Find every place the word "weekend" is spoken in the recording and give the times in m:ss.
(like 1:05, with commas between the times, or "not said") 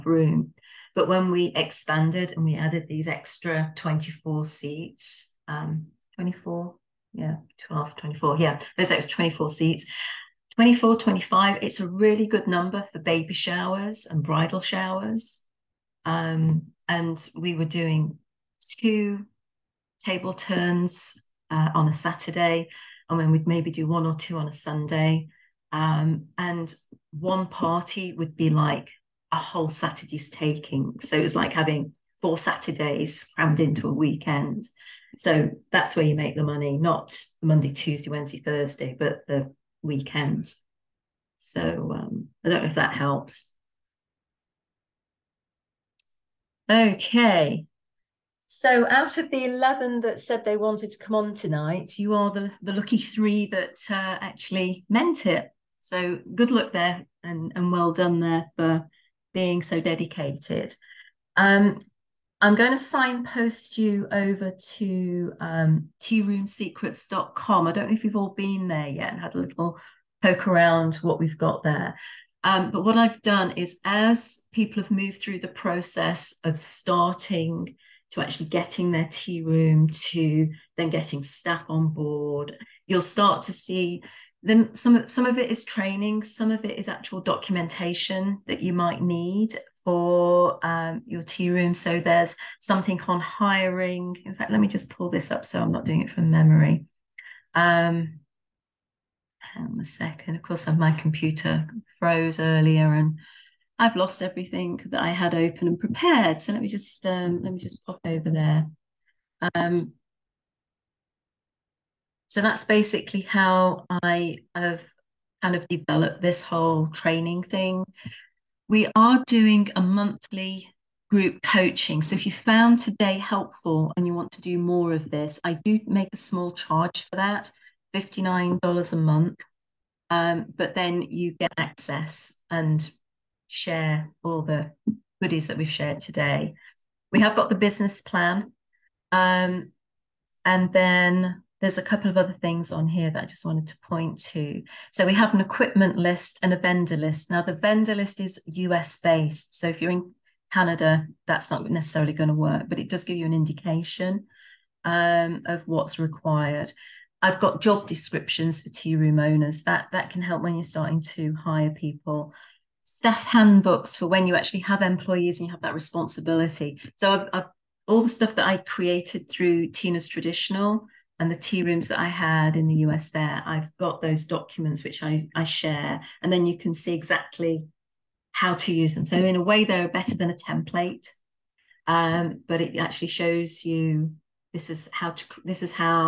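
0:33, 0:39.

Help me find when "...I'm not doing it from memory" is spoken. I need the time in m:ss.
1:35.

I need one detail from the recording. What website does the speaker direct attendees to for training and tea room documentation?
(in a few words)
tearoomsecrets.com.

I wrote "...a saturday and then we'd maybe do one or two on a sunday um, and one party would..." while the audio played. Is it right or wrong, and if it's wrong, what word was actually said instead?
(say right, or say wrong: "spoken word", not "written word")
right.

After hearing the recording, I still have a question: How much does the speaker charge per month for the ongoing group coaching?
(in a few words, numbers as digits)
$59.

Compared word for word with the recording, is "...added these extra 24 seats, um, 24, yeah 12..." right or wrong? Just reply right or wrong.
right.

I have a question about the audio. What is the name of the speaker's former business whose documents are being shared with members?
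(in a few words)
Tina's Traditional.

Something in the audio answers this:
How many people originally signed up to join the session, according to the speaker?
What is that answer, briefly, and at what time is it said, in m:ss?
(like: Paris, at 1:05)
11, at 0:49.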